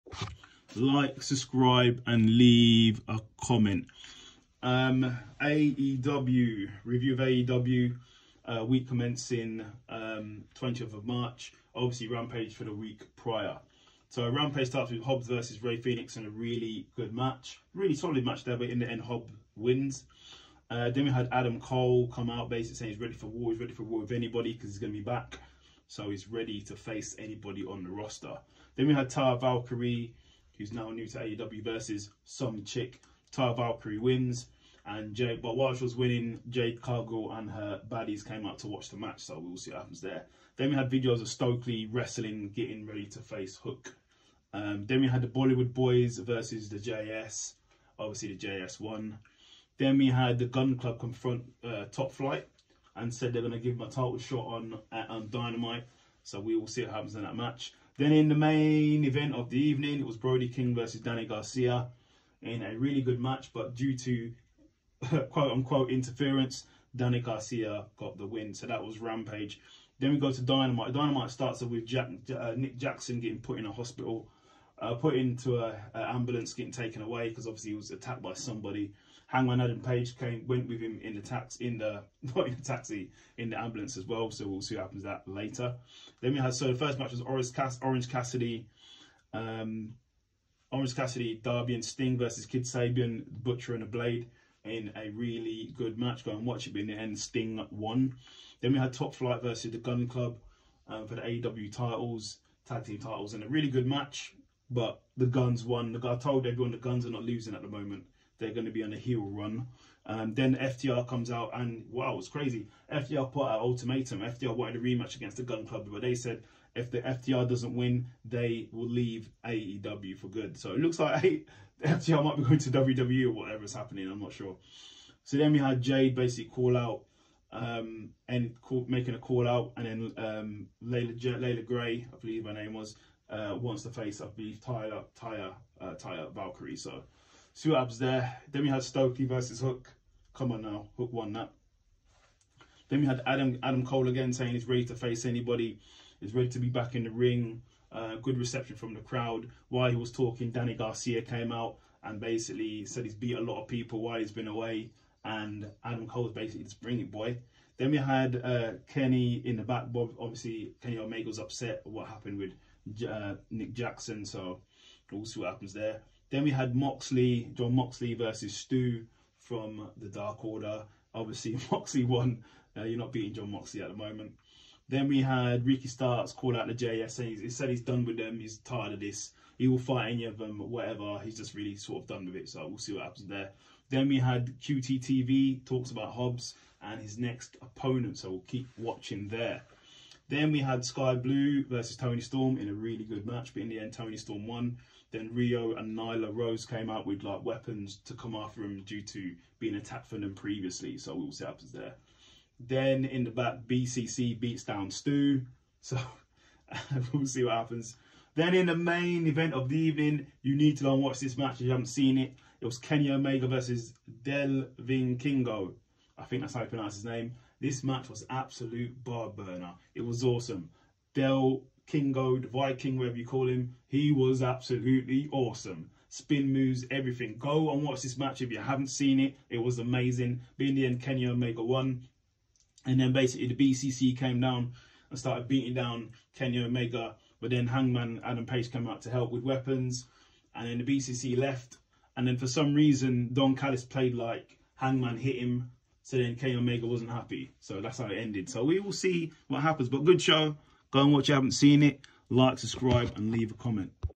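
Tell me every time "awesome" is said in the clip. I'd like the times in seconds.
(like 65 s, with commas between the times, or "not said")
220 s, 225 s.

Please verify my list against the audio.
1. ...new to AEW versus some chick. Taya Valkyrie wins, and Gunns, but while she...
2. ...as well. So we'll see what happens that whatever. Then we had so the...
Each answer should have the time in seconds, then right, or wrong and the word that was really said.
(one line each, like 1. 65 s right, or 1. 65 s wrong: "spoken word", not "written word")
1. 30 s wrong: "Jade", not "Gunns"
2. 83 s wrong: "later", not "whatever".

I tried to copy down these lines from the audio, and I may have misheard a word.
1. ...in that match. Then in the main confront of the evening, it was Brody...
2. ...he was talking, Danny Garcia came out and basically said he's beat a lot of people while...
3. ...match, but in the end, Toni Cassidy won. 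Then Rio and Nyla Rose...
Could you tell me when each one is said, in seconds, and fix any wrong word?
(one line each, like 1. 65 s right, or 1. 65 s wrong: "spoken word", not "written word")
1. 57 s wrong: "event", not "confront"
2. 149 s right
3. 193 s wrong: "Storm", not "Cassidy".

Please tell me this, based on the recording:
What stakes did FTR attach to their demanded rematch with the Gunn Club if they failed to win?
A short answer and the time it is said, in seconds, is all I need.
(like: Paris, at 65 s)
Leave AEW, at 118 s.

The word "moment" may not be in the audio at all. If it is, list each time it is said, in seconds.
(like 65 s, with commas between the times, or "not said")
107 s, 173 s.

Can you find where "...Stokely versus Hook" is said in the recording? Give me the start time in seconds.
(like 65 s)
138 s.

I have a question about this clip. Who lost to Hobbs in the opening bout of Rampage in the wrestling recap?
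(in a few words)
Rey Fenix.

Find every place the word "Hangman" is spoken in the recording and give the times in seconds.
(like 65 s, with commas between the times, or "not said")
79 s, 237 s, 244 s.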